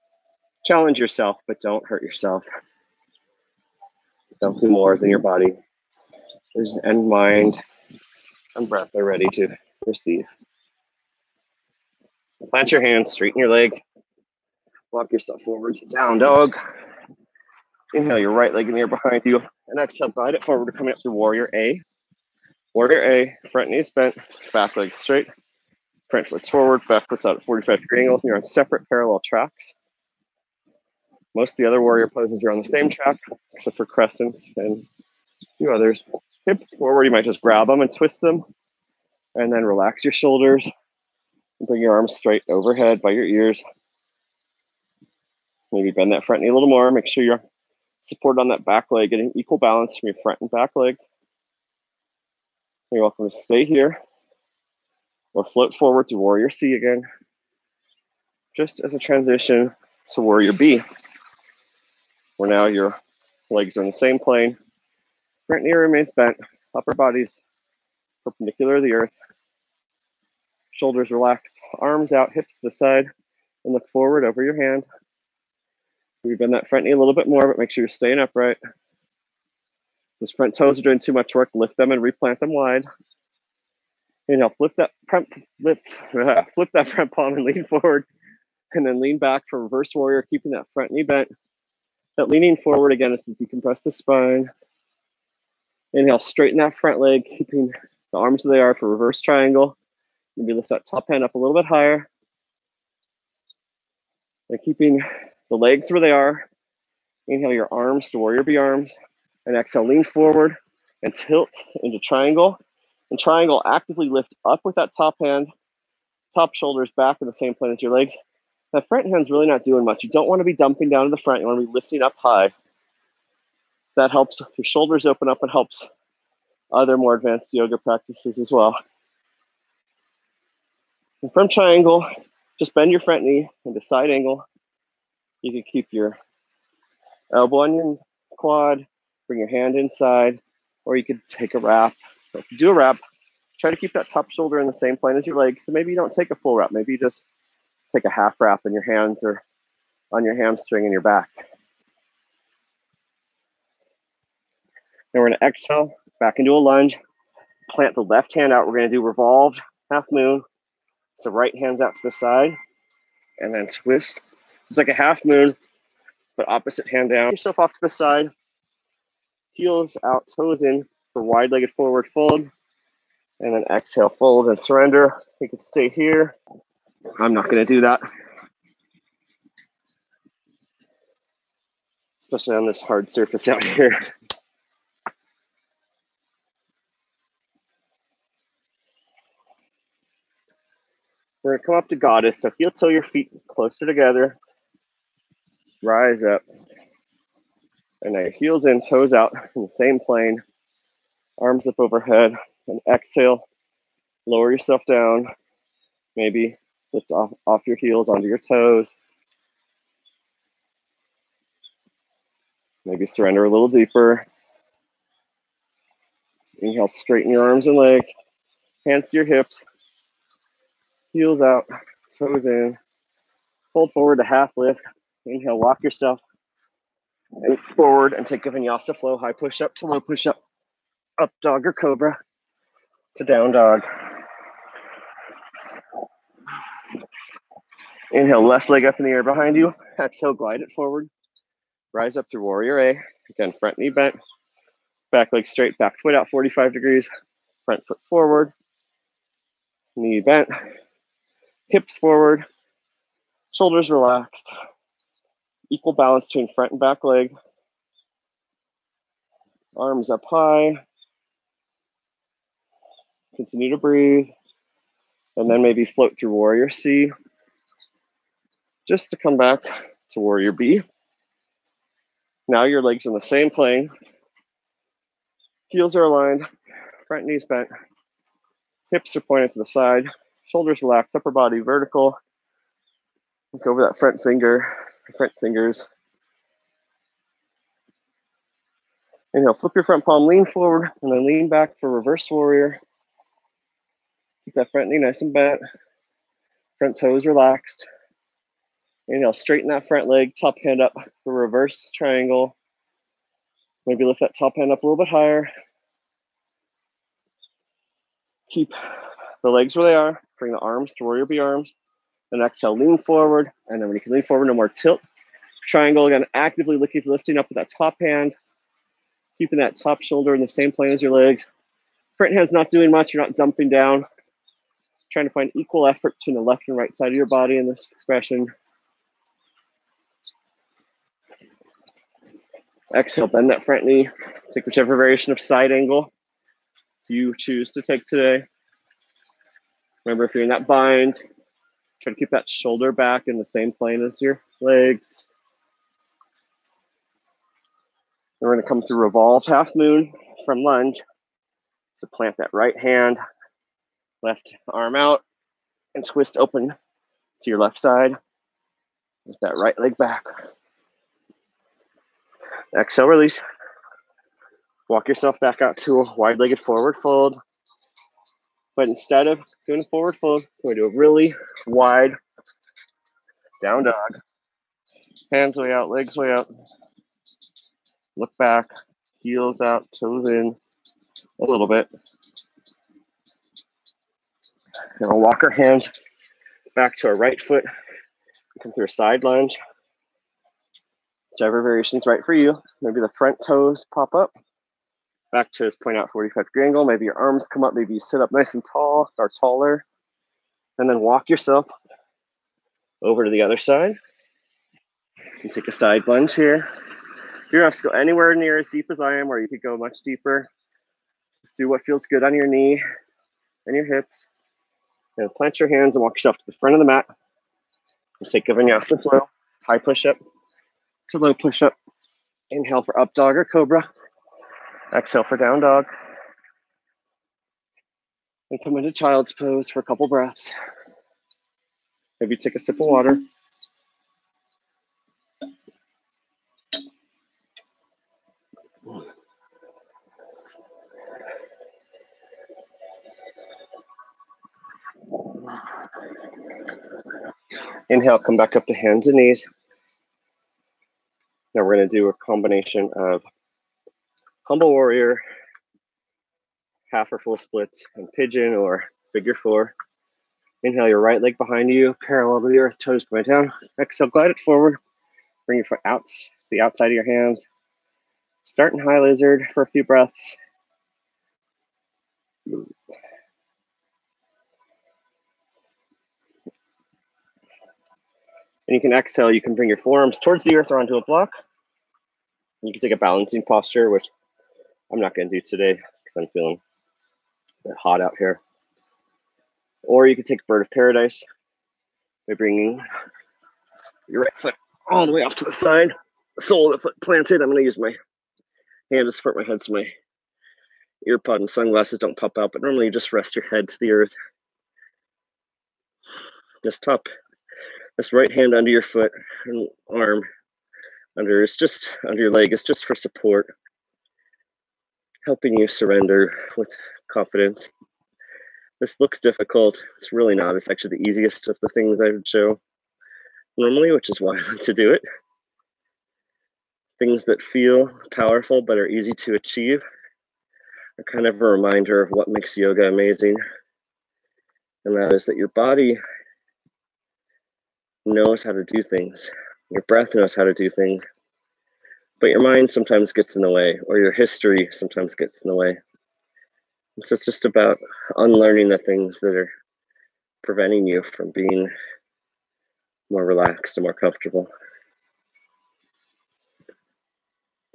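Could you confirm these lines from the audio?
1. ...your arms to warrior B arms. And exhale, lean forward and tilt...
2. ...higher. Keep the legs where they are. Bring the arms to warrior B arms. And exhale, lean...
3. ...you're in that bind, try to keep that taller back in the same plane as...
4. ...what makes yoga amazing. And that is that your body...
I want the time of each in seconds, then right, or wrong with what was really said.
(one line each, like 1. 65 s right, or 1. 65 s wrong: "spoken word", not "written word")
1. 107 s right
2. 305 s right
3. 340 s wrong: "shoulder", not "taller"
4. 532 s right.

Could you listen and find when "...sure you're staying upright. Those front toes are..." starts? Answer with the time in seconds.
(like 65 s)
77 s.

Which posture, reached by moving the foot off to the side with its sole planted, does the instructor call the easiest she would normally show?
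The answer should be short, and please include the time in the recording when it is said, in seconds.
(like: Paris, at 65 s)
Bird of Paradise, at 490 s.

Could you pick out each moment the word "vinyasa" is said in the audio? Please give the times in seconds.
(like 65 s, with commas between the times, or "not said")
228 s, 418 s.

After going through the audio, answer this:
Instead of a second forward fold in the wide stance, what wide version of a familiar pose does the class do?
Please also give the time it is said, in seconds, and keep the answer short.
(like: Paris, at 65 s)
Wide down dog, at 370 s.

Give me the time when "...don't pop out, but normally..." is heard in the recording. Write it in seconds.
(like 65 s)
501 s.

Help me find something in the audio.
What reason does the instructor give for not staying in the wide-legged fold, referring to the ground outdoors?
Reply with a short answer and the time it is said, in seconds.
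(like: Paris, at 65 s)
Hard surface, at 182 s.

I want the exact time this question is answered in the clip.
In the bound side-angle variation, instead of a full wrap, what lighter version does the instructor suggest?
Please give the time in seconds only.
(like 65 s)
148 s.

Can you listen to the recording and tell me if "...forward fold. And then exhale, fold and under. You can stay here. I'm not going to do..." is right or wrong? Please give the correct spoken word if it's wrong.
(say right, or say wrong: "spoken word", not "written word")
wrong: "surrender", not "under".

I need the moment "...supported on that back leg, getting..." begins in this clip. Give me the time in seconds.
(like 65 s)
48 s.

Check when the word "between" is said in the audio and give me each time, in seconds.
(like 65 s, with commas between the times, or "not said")
256 s, 326 s.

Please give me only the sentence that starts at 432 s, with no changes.
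Maybe take a sip of water.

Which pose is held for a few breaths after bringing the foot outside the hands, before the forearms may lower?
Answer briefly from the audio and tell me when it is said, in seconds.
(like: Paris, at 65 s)
High lizard, at 468 s.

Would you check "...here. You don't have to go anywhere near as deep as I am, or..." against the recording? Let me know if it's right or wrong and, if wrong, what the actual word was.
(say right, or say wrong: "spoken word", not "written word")
right.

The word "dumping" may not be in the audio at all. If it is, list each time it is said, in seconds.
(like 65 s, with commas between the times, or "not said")
120 s, 323 s.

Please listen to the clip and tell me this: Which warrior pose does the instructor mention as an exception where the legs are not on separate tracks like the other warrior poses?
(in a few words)
Crescent.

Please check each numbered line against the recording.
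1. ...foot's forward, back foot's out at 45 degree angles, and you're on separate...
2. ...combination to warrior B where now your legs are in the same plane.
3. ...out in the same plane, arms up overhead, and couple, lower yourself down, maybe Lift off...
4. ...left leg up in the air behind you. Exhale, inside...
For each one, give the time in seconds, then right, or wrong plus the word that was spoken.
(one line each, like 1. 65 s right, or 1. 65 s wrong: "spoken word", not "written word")
1. 26 s right
2. 58 s wrong: "transition", not "combination"
3. 199 s wrong: "exhale", not "couple"
4. 238 s wrong: "glide", not "inside".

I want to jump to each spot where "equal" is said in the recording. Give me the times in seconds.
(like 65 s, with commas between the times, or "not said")
49 s, 255 s, 325 s.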